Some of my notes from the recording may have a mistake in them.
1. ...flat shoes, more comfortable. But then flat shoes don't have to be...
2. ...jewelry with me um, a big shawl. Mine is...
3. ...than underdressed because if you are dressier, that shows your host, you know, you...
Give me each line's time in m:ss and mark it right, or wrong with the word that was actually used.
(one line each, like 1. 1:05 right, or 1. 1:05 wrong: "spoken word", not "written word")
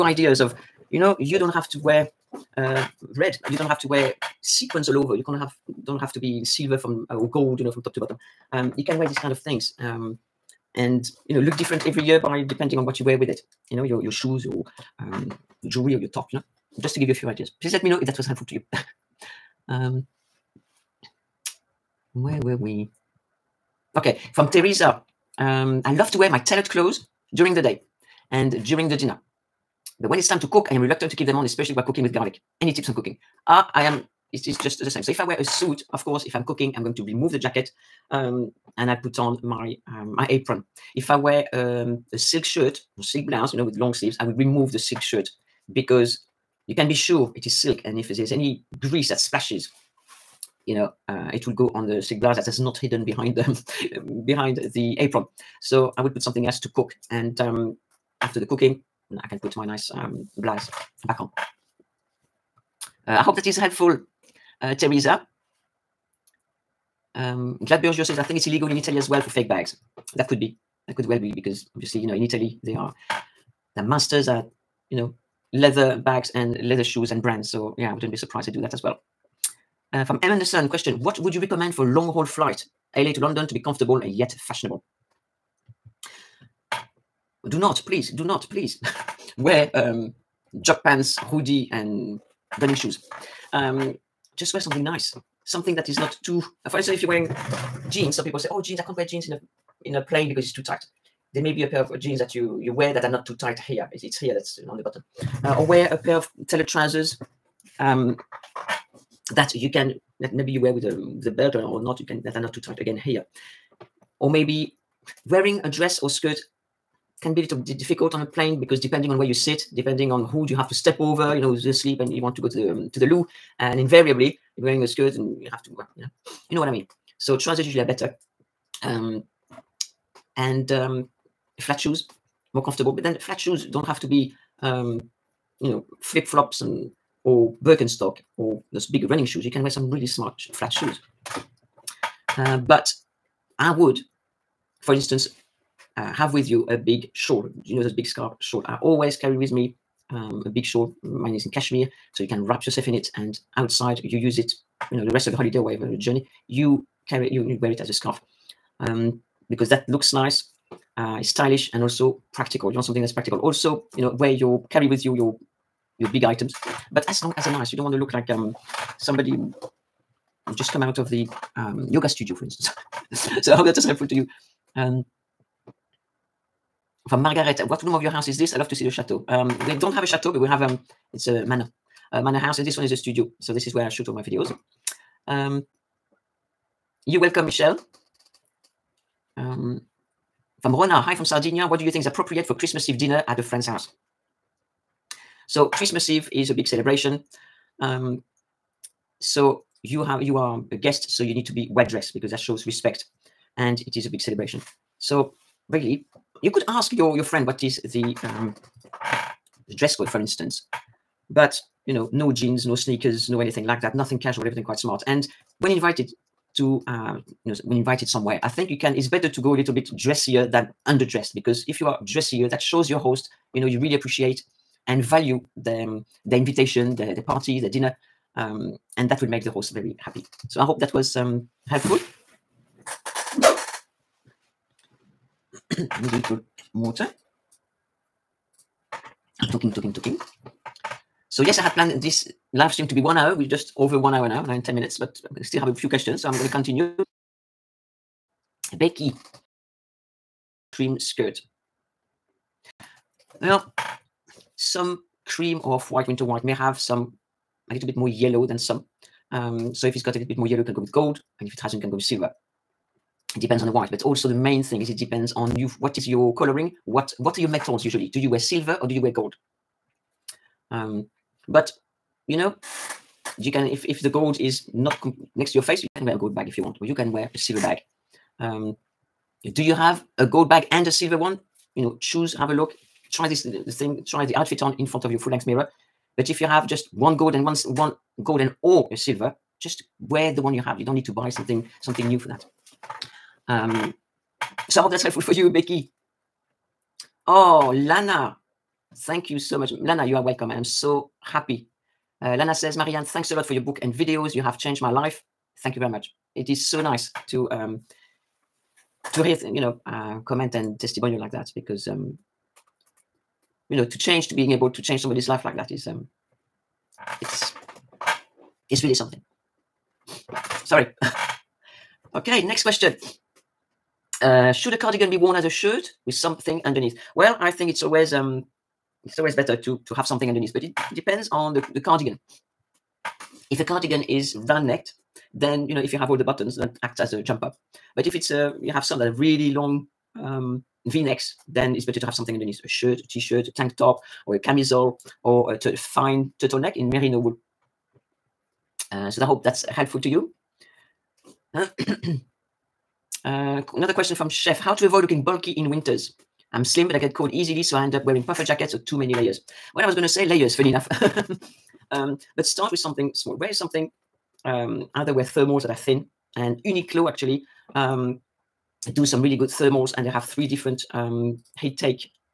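1. 2:11 right
2. 2:29 wrong: "carry", not "jewelry"
3. 3:40 right.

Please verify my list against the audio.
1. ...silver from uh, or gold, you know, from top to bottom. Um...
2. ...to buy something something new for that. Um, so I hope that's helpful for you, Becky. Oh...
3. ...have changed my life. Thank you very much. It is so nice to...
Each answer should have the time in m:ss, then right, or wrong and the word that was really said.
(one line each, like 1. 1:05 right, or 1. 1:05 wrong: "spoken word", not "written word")
1. 0:06 right
2. 4:51 right
3. 5:04 right.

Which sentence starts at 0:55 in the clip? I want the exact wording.
So I will put something else to cook.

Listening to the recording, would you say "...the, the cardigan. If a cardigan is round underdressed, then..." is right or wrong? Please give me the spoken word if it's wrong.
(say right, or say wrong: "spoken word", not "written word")
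wrong: "necked", not "underdressed".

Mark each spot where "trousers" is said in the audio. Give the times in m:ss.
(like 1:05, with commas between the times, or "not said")
1:46, 2:07.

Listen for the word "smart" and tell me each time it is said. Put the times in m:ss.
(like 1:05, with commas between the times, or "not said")
2:20, 3:34.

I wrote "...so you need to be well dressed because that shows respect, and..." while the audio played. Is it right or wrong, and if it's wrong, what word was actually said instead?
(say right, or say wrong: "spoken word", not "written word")
right.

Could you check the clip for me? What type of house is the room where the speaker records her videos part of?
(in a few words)
a manor house.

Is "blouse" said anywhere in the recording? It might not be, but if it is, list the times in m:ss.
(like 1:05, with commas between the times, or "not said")
0:43, 0:52, 1:00.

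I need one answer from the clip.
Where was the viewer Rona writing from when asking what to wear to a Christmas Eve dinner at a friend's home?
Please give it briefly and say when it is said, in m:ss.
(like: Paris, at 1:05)
Sardinia, at 3:11.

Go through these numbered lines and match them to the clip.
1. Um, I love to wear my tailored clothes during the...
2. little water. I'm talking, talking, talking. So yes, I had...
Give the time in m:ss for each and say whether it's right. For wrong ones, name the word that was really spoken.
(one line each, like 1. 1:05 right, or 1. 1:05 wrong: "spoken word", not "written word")
1. 0:25 right
2. 3:56 right.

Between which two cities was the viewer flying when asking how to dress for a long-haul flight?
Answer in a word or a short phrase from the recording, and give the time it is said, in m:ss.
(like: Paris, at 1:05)
LA to London, at 1:22.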